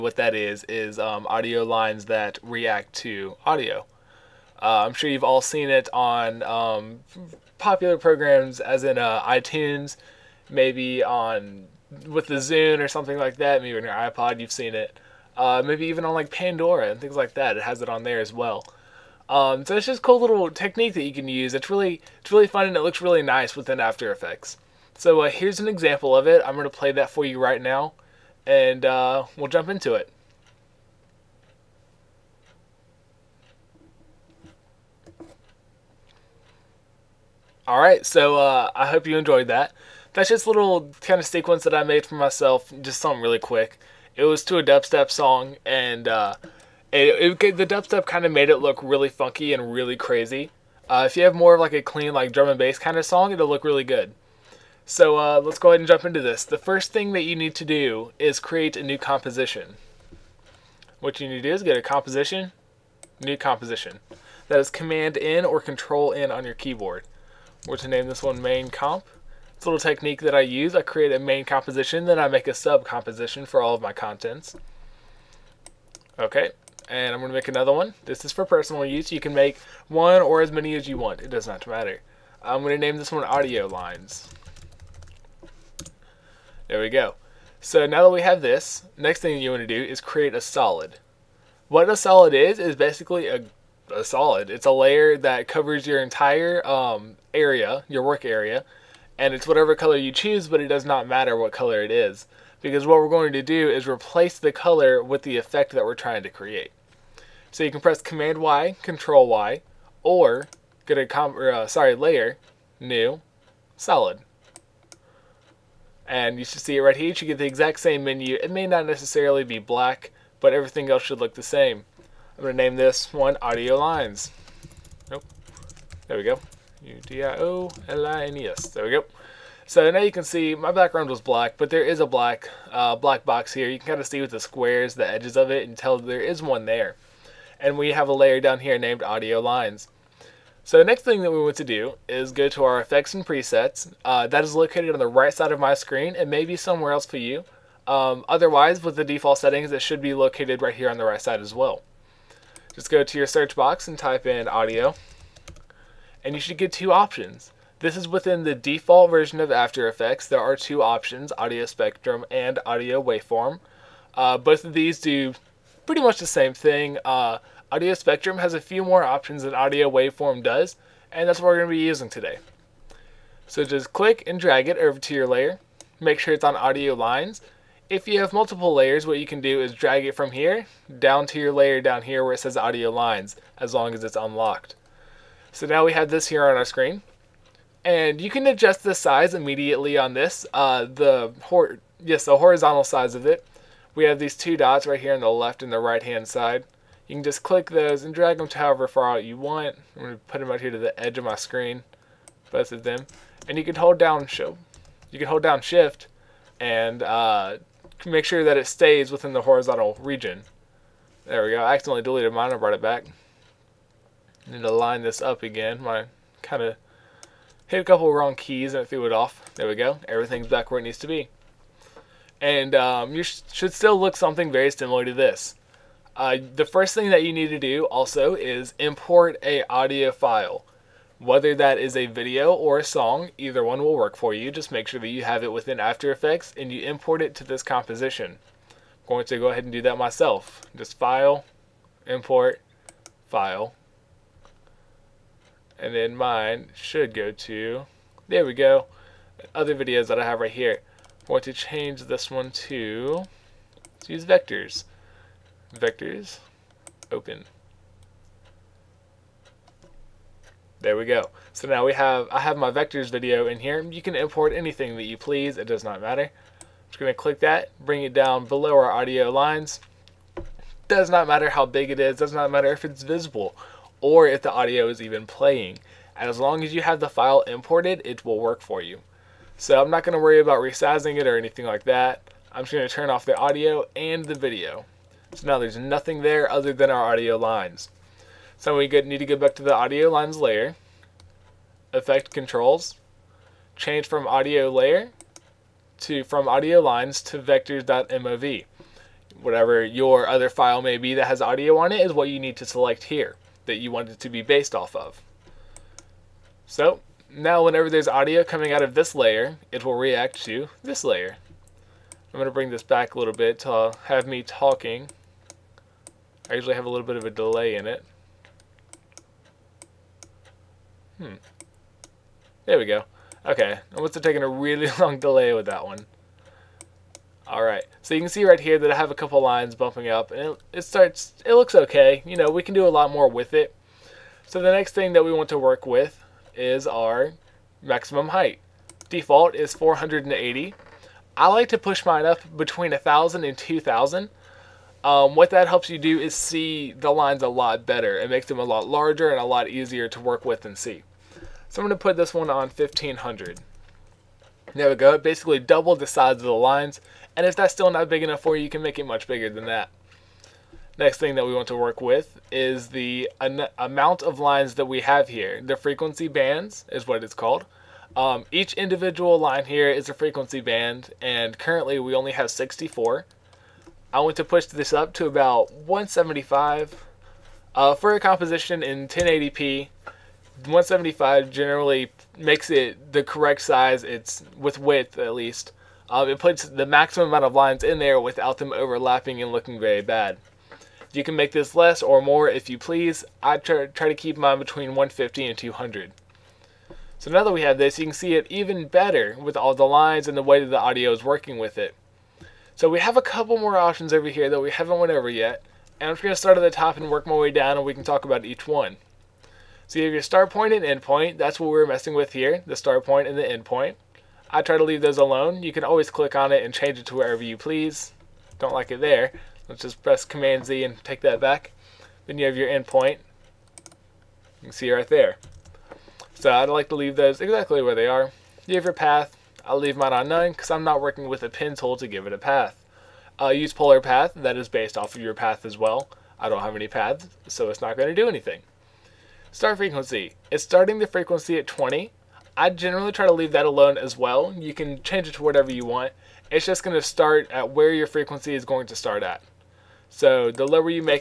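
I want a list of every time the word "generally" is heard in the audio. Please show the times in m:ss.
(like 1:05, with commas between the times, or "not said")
6:21, 7:22.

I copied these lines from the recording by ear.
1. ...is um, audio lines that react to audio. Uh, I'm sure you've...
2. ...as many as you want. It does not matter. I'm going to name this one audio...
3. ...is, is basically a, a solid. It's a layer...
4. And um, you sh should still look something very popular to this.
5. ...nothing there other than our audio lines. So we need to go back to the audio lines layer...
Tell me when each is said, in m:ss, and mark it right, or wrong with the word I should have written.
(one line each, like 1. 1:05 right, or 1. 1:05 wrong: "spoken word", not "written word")
1. 0:00 right
2. 1:20 right
3. 1:32 right
4. 3:42 wrong: "similar", not "popular"
5. 4:45 right.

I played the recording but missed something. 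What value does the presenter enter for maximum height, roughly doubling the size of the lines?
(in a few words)
1,500.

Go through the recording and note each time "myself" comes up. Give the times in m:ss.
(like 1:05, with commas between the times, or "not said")
0:42, 3:59.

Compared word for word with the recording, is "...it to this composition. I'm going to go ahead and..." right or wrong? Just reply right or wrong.
right.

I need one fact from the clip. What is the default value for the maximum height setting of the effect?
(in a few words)
480.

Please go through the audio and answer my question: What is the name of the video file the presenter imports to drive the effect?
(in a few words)
vectors.mov.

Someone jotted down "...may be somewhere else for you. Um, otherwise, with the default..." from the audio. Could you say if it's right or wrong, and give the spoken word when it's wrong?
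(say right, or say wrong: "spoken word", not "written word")
right.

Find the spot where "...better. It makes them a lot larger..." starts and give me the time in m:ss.
5:47.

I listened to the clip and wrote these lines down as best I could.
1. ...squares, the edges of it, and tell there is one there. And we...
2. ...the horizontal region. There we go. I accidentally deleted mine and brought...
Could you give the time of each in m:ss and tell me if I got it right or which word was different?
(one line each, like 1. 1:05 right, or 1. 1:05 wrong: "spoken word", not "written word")
1. 2:14 right
2. 3:29 right.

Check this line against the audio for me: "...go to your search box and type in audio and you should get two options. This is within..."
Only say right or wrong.
right.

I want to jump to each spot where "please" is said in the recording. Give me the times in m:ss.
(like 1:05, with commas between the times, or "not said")
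4:25, 6:32, 6:57.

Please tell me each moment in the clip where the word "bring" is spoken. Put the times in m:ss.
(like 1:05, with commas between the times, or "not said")
4:27, 5:12.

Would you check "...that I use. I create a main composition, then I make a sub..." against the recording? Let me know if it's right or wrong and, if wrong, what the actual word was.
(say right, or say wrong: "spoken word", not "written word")
right.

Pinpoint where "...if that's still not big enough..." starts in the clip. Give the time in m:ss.
5:57.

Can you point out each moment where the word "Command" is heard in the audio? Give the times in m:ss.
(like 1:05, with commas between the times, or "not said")
1:04, 1:48, 7:00.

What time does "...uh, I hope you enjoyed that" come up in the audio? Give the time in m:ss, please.
0:38.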